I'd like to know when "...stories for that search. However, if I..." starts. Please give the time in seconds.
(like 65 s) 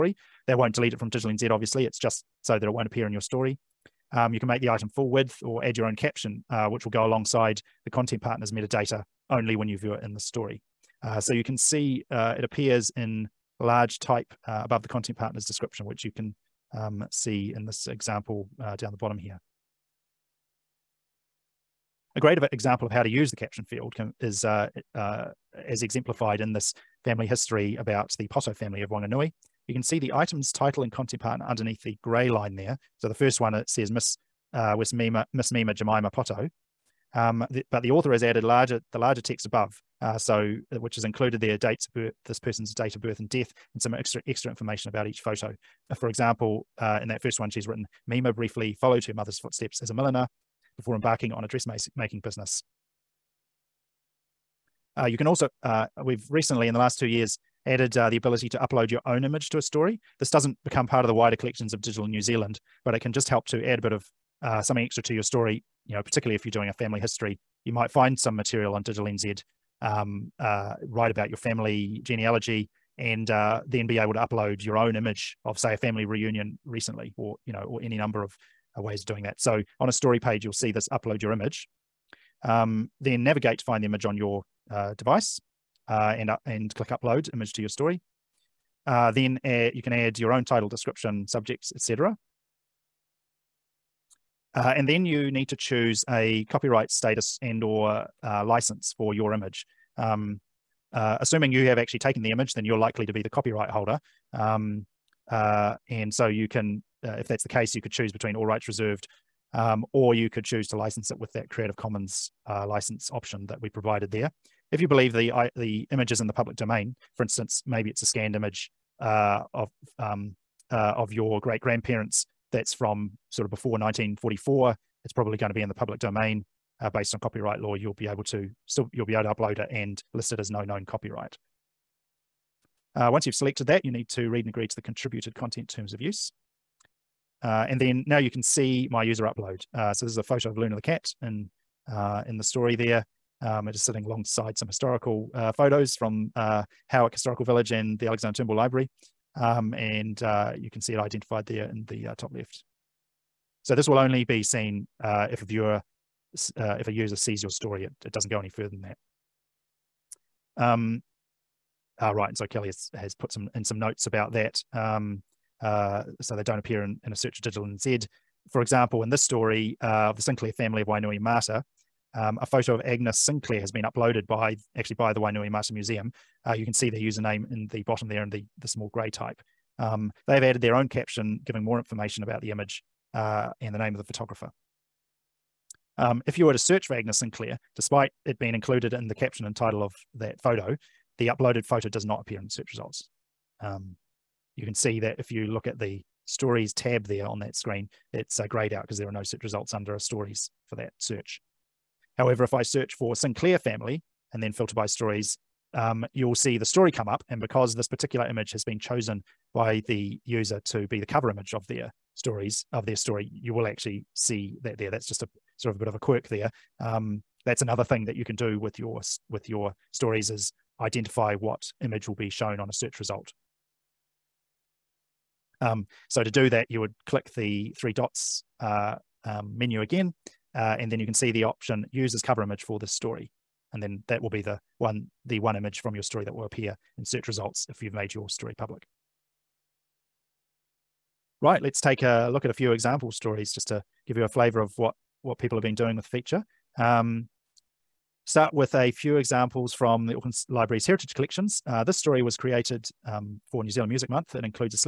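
199 s.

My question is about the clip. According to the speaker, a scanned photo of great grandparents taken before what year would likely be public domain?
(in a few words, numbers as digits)
1944.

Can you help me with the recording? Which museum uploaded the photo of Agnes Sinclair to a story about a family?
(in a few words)
Wainuiomata Museum.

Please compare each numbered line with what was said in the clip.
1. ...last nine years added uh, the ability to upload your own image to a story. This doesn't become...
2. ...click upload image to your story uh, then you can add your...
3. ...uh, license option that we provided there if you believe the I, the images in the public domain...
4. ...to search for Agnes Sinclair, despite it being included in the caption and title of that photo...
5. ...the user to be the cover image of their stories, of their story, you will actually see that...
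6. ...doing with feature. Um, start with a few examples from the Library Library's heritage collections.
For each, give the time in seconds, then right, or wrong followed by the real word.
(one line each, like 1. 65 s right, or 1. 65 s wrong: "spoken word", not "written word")
1. 56 s wrong: "two", not "nine"
2. 86 s right
3. 112 s right
4. 186 s right
5. 209 s right
6. 245 s wrong: "Auckland", not "Library".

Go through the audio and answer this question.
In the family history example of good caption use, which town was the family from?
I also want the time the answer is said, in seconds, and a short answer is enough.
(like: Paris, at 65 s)
Wanganui, at 28 s.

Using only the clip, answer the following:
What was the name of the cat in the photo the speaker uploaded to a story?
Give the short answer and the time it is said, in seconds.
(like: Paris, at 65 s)
Luna, at 140 s.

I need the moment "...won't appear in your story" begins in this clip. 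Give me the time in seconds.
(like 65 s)
2 s.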